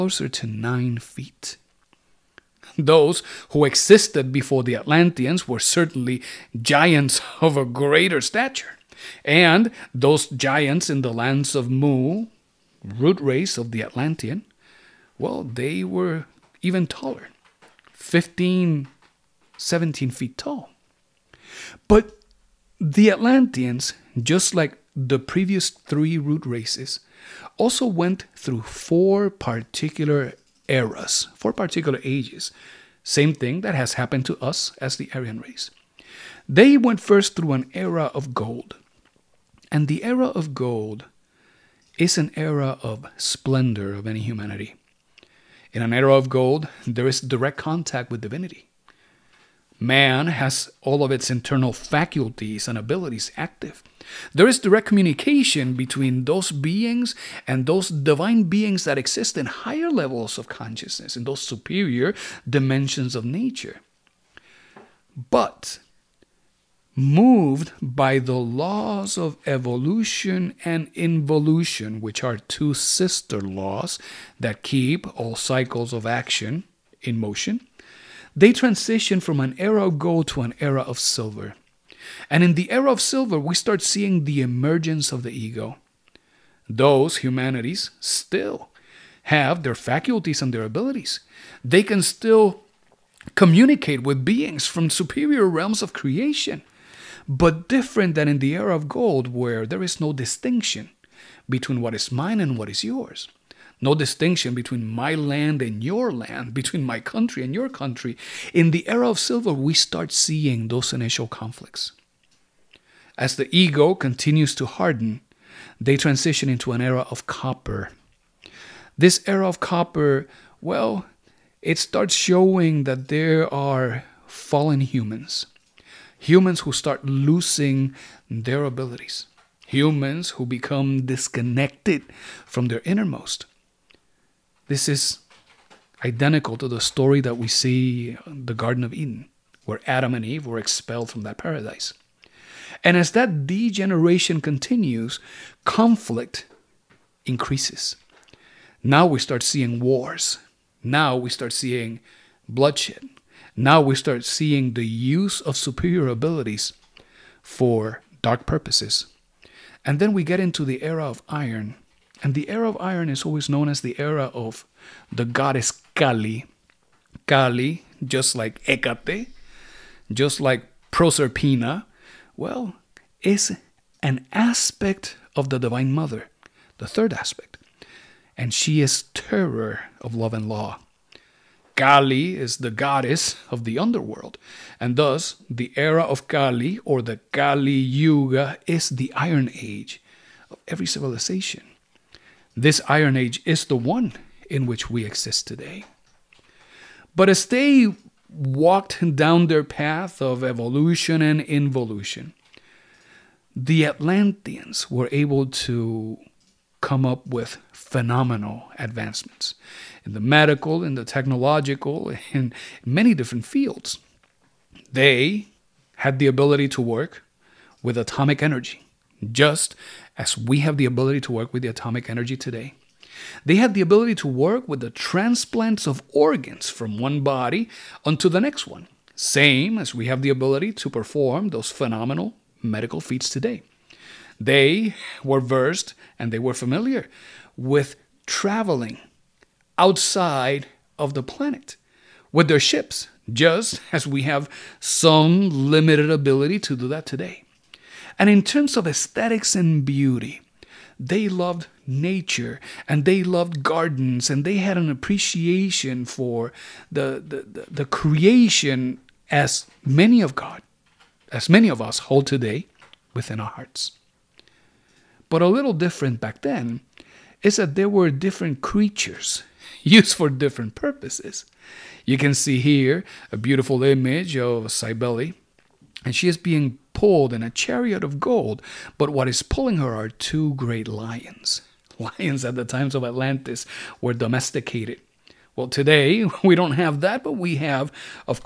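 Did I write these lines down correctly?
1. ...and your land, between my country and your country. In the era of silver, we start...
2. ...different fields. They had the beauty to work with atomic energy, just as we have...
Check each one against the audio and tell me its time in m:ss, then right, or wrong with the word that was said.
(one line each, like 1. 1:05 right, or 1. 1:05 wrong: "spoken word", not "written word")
1. 1:45 right
2. 3:33 wrong: "ability", not "beauty".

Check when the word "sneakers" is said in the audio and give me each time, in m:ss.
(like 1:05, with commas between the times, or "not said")
not said.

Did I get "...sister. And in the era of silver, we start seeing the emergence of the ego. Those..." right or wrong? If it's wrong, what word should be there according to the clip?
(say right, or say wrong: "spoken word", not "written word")
wrong: "silver", not "sister".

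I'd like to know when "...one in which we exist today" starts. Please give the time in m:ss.
3:13.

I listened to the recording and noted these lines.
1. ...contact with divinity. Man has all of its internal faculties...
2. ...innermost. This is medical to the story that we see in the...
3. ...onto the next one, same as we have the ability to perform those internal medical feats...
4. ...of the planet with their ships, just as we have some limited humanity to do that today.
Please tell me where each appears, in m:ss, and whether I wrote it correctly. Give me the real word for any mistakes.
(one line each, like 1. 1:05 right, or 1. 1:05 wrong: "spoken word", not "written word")
1. 0:47 right
2. 2:12 wrong: "identical", not "medical"
3. 3:48 wrong: "phenomenal", not "internal"
4. 4:00 wrong: "ability", not "humanity".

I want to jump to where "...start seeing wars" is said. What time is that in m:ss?
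2:29.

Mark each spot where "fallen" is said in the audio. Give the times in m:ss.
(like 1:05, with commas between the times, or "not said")
2:04.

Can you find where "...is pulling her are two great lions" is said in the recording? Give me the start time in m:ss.
4:39.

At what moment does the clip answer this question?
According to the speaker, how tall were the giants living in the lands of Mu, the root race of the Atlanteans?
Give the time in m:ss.
0:17.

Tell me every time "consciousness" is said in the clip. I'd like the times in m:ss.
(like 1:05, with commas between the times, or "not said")
1:00.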